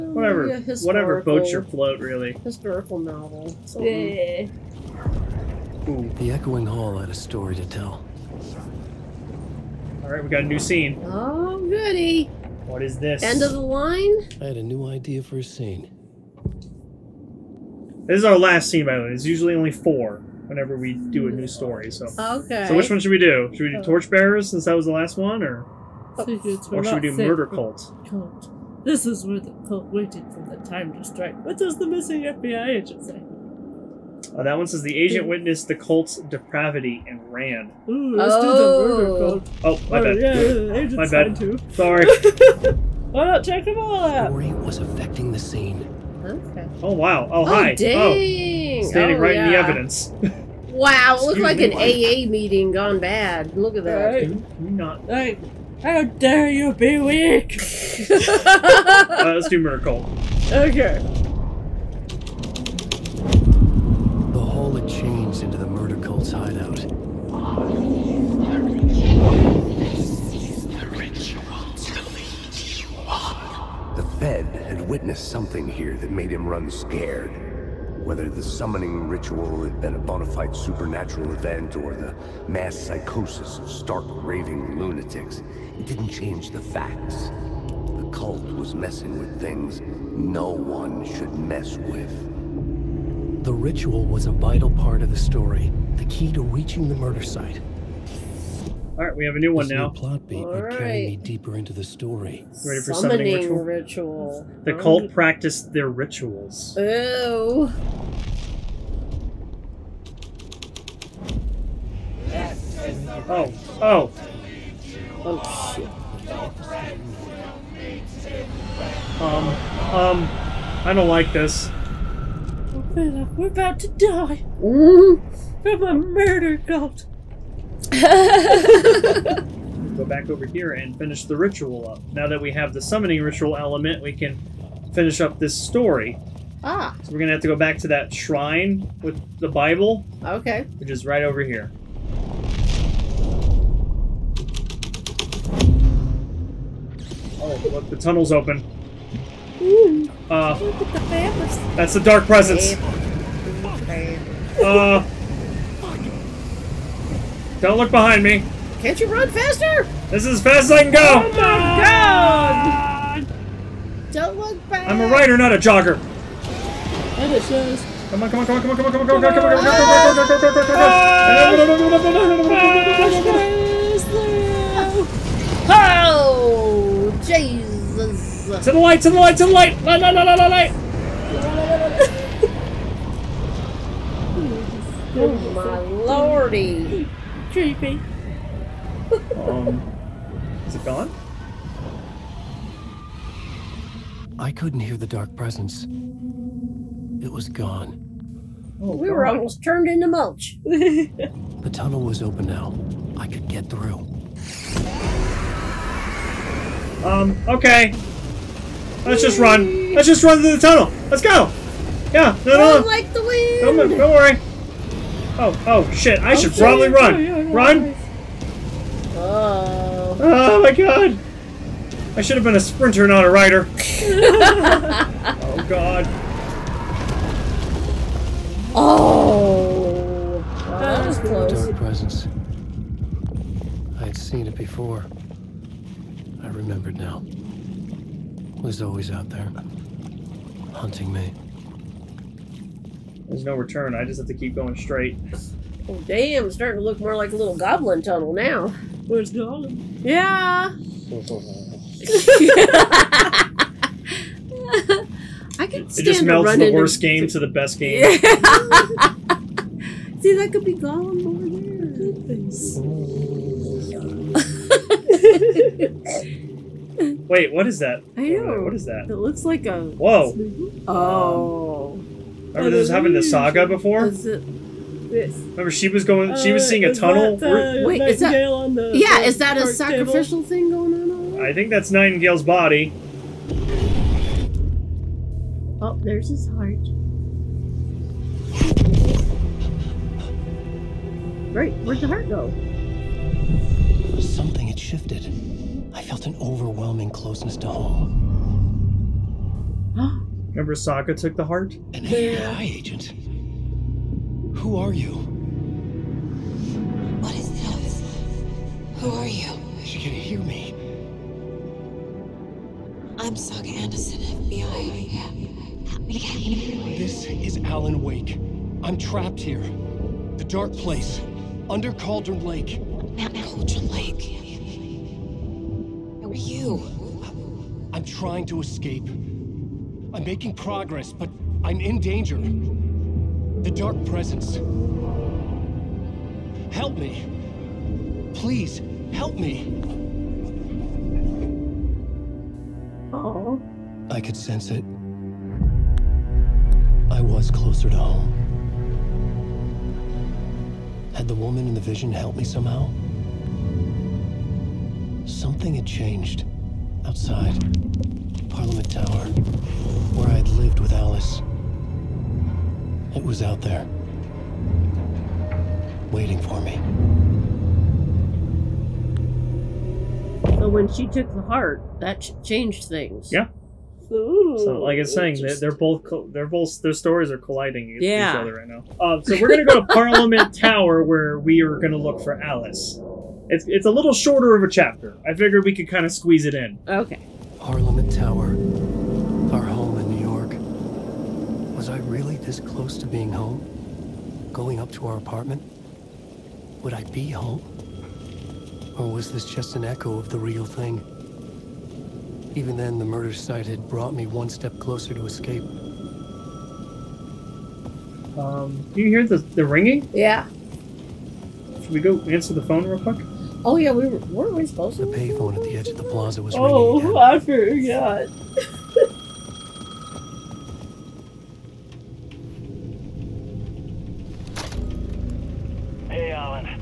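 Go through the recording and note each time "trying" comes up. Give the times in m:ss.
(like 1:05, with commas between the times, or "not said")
5:28.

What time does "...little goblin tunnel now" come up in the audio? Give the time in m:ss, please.
4:07.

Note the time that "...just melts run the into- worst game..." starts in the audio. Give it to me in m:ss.
4:16.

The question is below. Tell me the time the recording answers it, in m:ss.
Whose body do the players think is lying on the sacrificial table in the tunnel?
4:41.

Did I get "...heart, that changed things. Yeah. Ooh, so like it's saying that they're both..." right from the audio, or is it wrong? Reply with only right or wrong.
right.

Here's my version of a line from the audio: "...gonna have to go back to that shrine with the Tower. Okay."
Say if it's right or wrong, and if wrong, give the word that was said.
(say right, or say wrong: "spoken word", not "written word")
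wrong: "Bible", not "Tower".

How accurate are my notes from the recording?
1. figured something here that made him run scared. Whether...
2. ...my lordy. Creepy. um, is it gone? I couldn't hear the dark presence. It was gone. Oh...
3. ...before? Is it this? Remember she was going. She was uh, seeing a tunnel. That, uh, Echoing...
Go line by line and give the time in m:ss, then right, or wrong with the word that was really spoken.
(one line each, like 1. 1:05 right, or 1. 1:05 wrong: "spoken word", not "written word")
1. 1:14 wrong: "witnessed", not "figured"
2. 3:05 right
3. 4:33 wrong: "Wait", not "Echoing".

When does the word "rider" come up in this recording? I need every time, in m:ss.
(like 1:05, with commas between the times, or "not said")
2:45, 3:43.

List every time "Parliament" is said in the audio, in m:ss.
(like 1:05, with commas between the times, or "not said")
5:58, 6:19.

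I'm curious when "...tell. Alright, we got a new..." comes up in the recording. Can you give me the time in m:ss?
0:07.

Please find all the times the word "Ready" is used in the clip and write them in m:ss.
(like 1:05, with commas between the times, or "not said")
1:42.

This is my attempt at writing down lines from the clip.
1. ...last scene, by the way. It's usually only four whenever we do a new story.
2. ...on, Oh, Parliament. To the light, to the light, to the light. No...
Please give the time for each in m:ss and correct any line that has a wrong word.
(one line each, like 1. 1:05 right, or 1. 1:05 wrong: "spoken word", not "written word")
1. 0:18 right
2. 2:53 wrong: "Jesus", not "Parliament".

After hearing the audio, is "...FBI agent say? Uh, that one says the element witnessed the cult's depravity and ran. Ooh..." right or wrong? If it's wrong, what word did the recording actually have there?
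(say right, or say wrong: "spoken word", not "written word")
wrong: "agent", not "element".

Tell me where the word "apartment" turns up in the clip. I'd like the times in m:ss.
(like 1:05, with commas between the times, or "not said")
6:35.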